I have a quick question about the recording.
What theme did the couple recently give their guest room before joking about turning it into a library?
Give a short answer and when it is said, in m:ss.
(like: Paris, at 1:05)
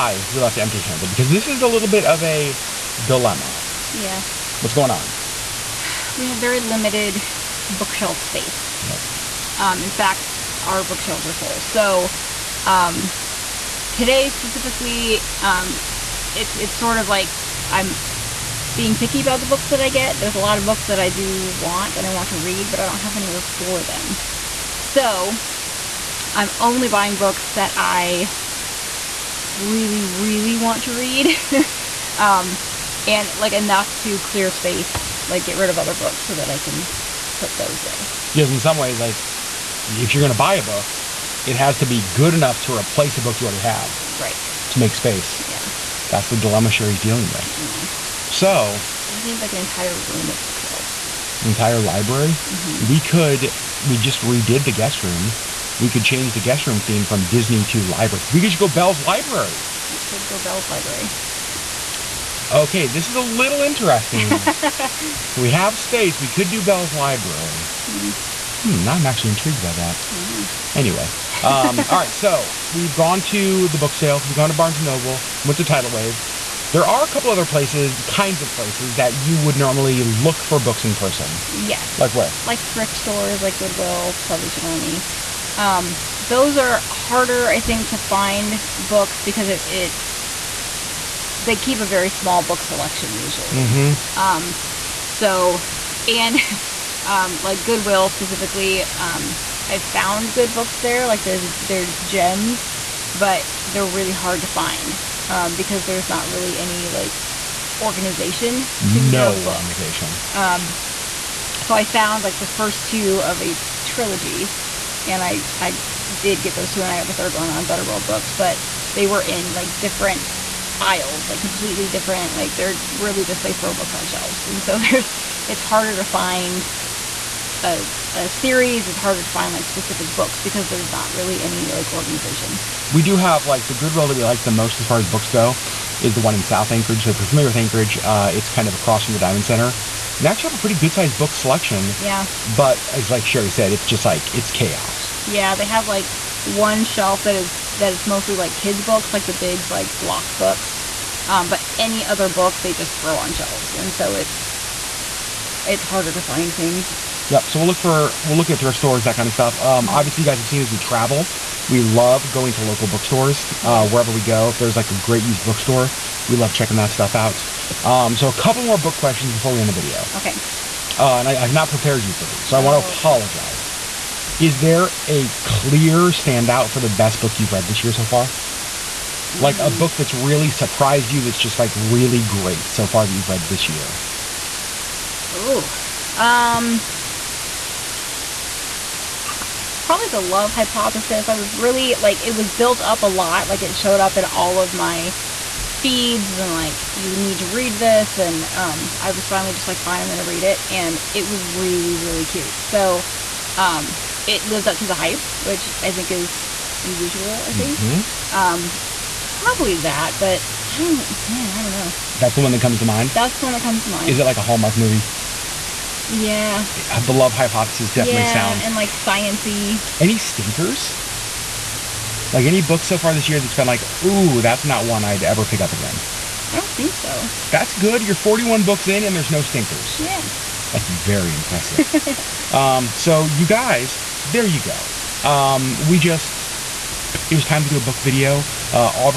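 Disney, at 0:57.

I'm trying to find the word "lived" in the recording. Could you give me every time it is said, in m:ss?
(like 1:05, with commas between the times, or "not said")
3:24.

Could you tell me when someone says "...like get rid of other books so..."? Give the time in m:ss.
0:35.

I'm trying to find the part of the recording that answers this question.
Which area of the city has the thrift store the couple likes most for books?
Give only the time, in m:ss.
2:16.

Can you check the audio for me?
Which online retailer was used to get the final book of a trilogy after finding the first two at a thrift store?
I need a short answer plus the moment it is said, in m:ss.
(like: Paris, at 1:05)
Better World Books, at 1:57.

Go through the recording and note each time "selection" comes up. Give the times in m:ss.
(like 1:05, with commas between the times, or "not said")
1:32, 2:21.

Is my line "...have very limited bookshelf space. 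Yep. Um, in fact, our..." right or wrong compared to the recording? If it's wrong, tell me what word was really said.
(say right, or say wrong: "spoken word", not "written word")
right.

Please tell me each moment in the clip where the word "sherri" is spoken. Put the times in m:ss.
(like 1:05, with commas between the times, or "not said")
0:46, 2:23.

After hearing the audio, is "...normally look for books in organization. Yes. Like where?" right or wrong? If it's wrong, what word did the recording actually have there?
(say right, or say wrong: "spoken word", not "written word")
wrong: "person", not "organization".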